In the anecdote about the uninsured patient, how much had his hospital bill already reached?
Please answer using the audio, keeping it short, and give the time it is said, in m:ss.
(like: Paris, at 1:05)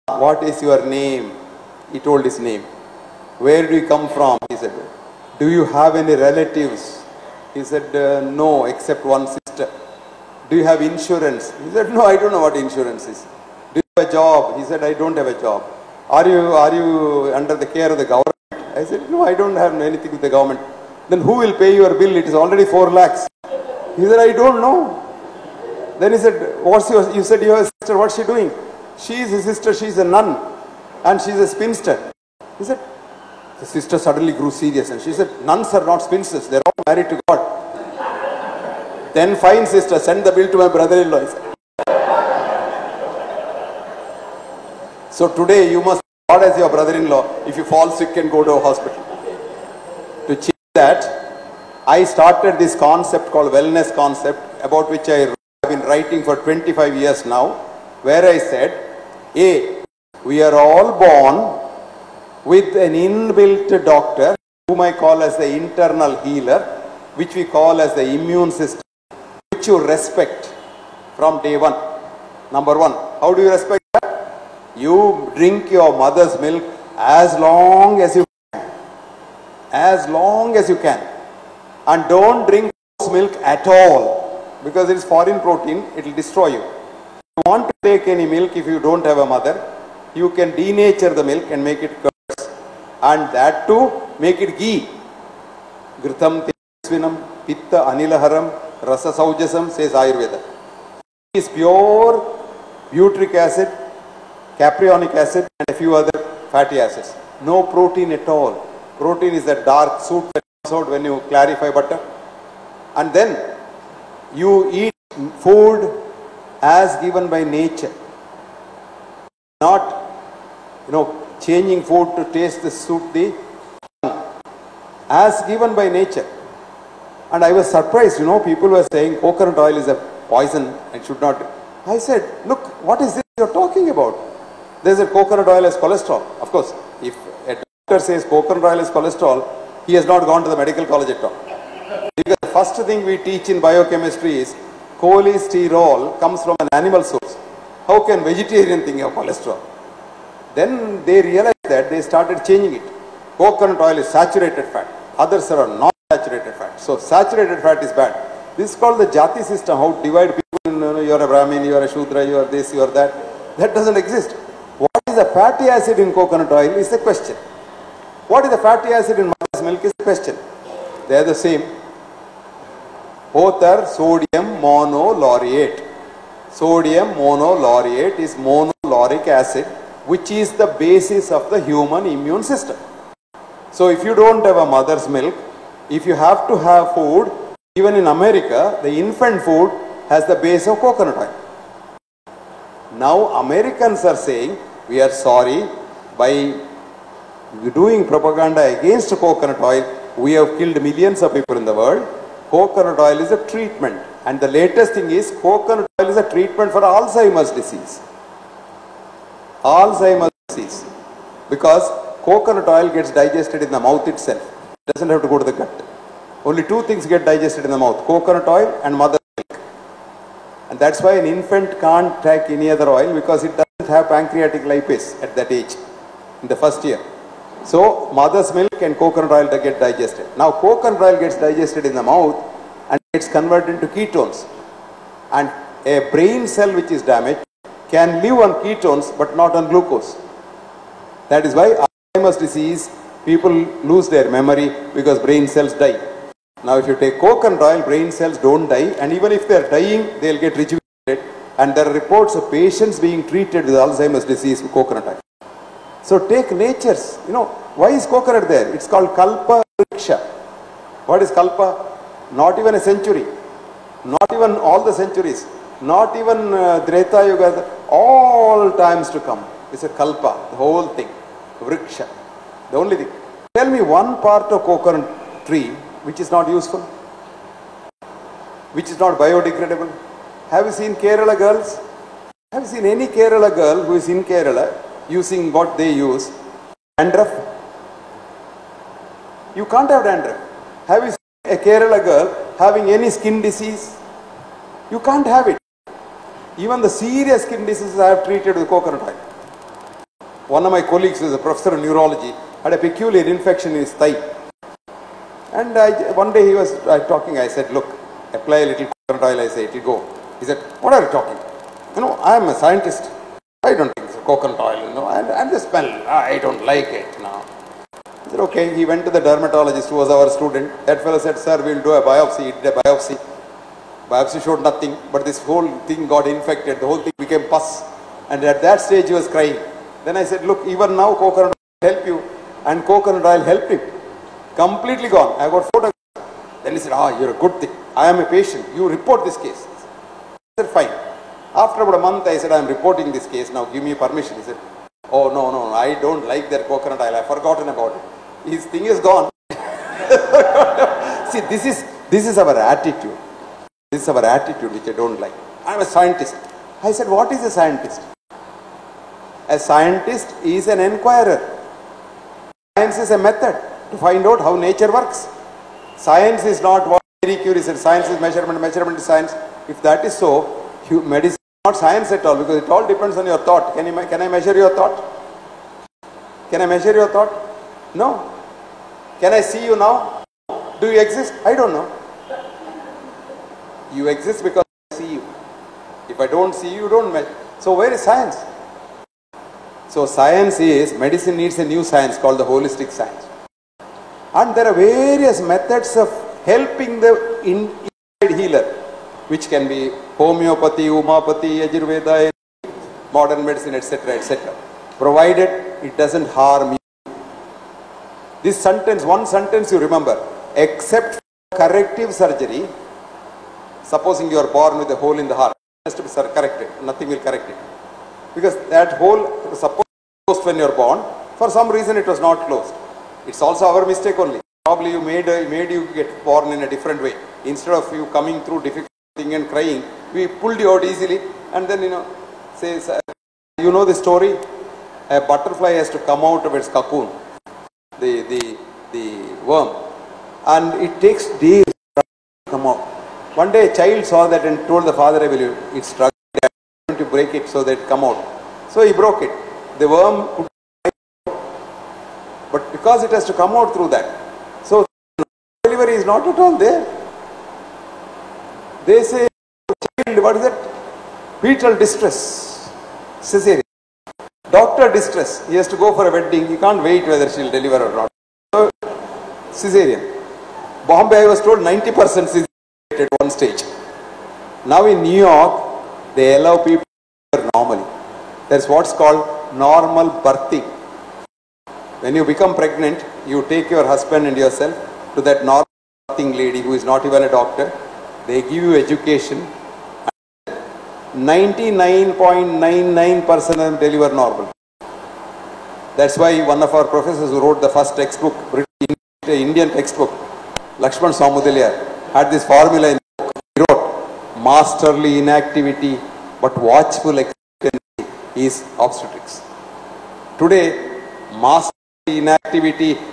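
4 lakhs, at 0:22.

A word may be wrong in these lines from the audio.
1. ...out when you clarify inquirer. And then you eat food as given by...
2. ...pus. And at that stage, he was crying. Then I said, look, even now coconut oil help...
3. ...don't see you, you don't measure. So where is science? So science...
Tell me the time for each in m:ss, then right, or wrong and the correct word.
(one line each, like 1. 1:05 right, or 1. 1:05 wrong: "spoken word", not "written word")
1. 1:50 wrong: "butter", not "inquirer"
2. 5:27 right
3. 6:26 right.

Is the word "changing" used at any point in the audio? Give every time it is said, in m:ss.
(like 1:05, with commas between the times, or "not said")
2:01, 2:32.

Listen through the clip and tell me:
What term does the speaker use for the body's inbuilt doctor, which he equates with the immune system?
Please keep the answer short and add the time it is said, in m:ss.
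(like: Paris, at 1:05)
internal healer, at 1:05.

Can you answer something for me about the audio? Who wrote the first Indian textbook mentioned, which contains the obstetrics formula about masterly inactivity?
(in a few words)
Lakshmanaswami Mudaliar.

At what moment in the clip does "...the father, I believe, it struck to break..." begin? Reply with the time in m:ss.
7:24.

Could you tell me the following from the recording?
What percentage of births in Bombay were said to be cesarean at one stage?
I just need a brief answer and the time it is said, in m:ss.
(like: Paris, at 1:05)
90%, at 7:51.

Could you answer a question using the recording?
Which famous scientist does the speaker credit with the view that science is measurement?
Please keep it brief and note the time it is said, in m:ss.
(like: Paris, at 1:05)
Marie Curie, at 6:07.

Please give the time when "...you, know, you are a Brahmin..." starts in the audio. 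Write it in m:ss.
2:40.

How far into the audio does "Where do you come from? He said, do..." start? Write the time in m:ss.
0:03.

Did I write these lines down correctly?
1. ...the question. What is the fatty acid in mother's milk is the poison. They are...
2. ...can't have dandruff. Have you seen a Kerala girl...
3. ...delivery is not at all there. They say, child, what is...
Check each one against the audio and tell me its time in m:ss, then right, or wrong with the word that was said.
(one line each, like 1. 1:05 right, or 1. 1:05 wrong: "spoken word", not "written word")
1. 2:46 wrong: "question", not "poison"
2. 4:49 right
3. 7:35 right.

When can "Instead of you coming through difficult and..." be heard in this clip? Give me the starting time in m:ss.
7:07.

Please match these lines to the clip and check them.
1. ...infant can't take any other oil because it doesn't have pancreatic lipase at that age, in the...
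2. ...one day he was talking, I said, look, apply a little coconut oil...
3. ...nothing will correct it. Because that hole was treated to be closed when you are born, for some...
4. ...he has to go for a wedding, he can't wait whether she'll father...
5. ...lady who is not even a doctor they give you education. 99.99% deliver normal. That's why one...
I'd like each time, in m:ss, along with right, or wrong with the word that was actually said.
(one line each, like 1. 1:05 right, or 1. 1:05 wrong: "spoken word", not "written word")
1. 3:41 right
2. 5:06 right
3. 6:56 wrong: "supposed", not "treated"
4. 7:45 wrong: "deliver", not "father"
5. 8:06 right.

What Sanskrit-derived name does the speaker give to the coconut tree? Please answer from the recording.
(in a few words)
Kalpa Riksha.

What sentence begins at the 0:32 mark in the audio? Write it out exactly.
He said, the sister suddenly grew serious and she said, nuns are not spinsters, they're all married to God.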